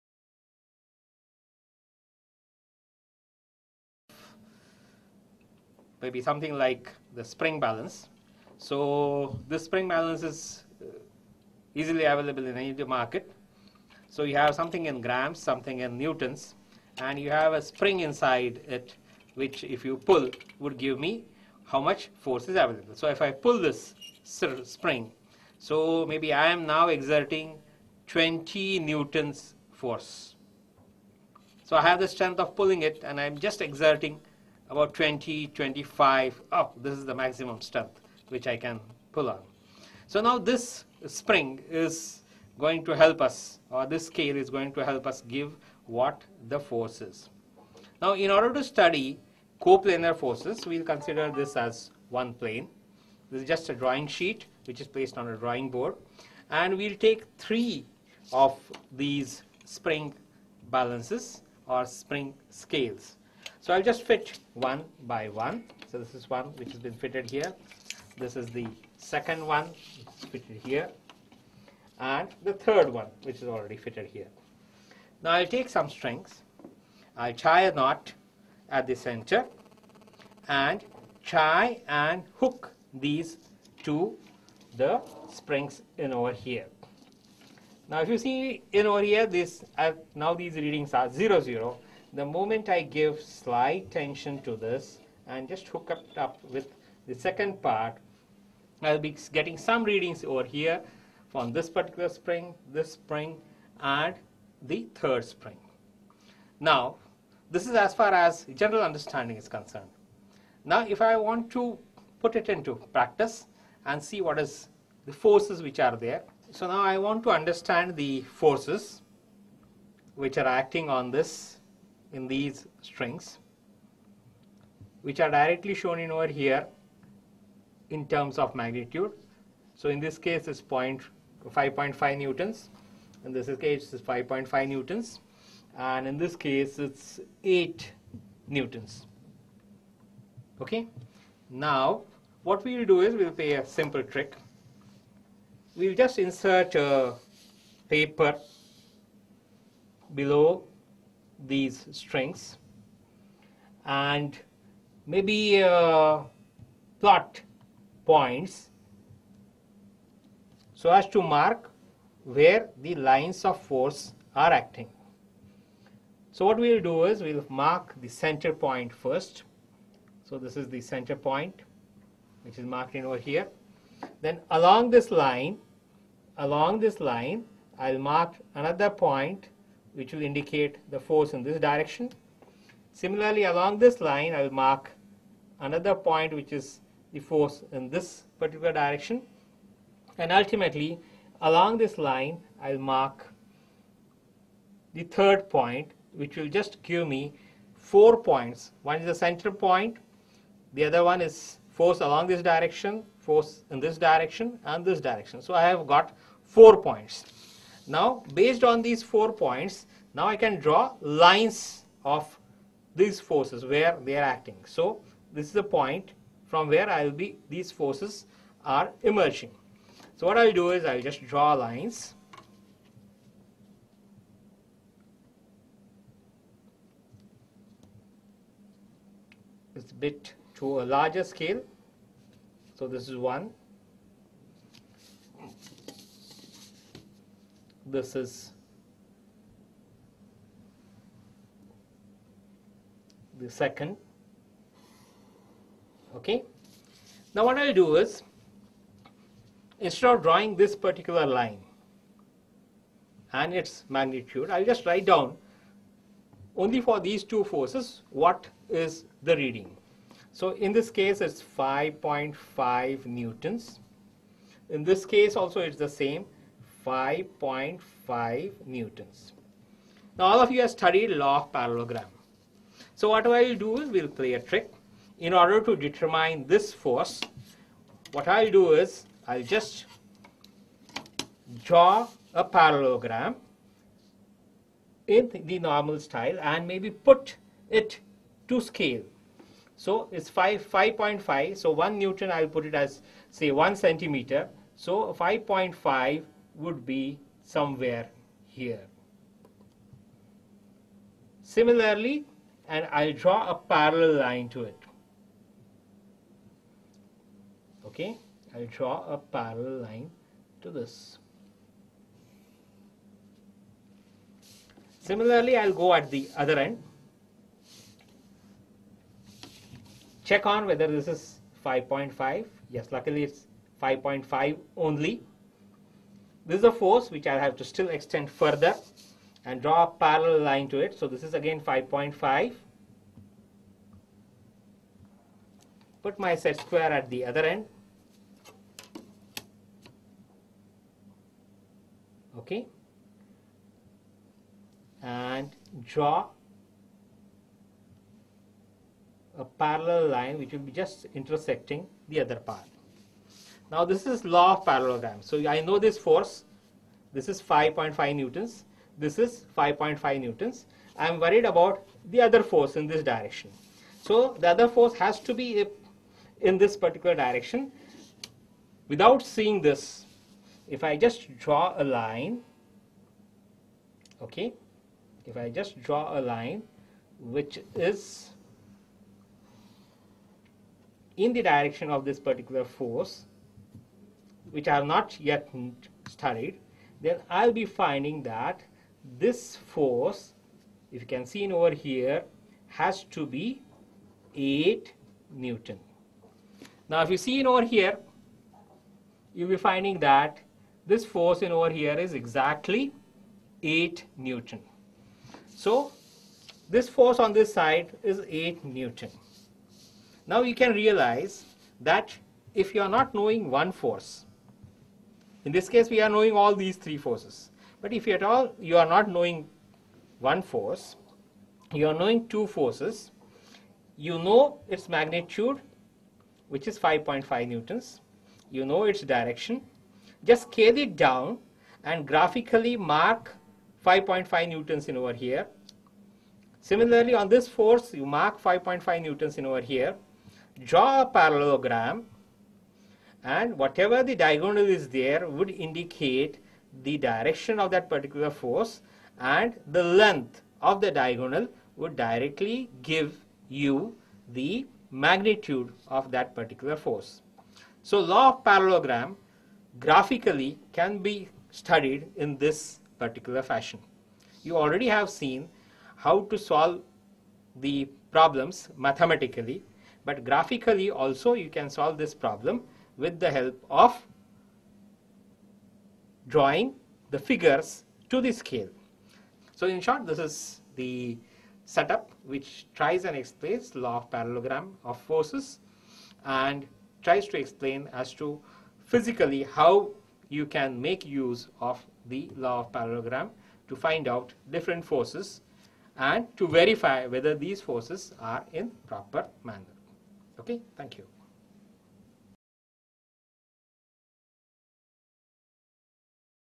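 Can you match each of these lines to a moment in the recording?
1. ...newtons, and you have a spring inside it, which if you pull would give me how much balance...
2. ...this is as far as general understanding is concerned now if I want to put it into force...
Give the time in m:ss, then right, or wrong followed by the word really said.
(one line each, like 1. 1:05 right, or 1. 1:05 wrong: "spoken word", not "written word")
1. 0:15 wrong: "force", not "balance"
2. 1:47 wrong: "practice", not "force".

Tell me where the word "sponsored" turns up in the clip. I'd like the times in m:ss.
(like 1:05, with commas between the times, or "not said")
not said.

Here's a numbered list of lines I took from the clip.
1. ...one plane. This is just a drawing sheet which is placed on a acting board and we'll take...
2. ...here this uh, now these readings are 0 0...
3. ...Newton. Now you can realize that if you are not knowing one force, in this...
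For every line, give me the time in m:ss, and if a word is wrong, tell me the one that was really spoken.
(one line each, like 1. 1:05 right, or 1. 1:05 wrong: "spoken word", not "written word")
1. 0:52 wrong: "drawing", not "acting"
2. 1:29 right
3. 6:48 right.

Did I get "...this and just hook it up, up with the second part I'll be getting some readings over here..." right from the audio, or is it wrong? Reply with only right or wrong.
right.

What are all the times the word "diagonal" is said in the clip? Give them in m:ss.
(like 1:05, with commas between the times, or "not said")
7:24, 7:30.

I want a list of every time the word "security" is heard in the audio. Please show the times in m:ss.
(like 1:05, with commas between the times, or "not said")
not said.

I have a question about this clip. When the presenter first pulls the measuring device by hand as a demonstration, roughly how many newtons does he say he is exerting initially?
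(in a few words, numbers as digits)
20 newtons.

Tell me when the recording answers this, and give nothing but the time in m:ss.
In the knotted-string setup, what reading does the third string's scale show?
2:17.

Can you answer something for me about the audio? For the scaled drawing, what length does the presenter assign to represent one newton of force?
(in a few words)
1 centimeter.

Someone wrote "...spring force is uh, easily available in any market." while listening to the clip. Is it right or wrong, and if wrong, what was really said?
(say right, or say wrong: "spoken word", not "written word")
wrong: "balance", not "force".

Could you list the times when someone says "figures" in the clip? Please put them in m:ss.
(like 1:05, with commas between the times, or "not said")
7:57.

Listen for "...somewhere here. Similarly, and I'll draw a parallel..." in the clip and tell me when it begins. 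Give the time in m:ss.
4:57.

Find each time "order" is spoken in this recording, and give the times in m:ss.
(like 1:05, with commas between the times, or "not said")
0:48, 4:35.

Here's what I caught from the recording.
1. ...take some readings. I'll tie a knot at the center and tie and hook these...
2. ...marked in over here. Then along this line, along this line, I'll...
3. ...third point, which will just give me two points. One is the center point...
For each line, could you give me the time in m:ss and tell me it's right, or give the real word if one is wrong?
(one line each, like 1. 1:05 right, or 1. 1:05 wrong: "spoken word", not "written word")
1. 1:15 wrong: "strings", not "readings"
2. 2:52 right
3. 3:15 wrong: "four", not "two".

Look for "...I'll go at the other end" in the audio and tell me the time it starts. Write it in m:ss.
5:15.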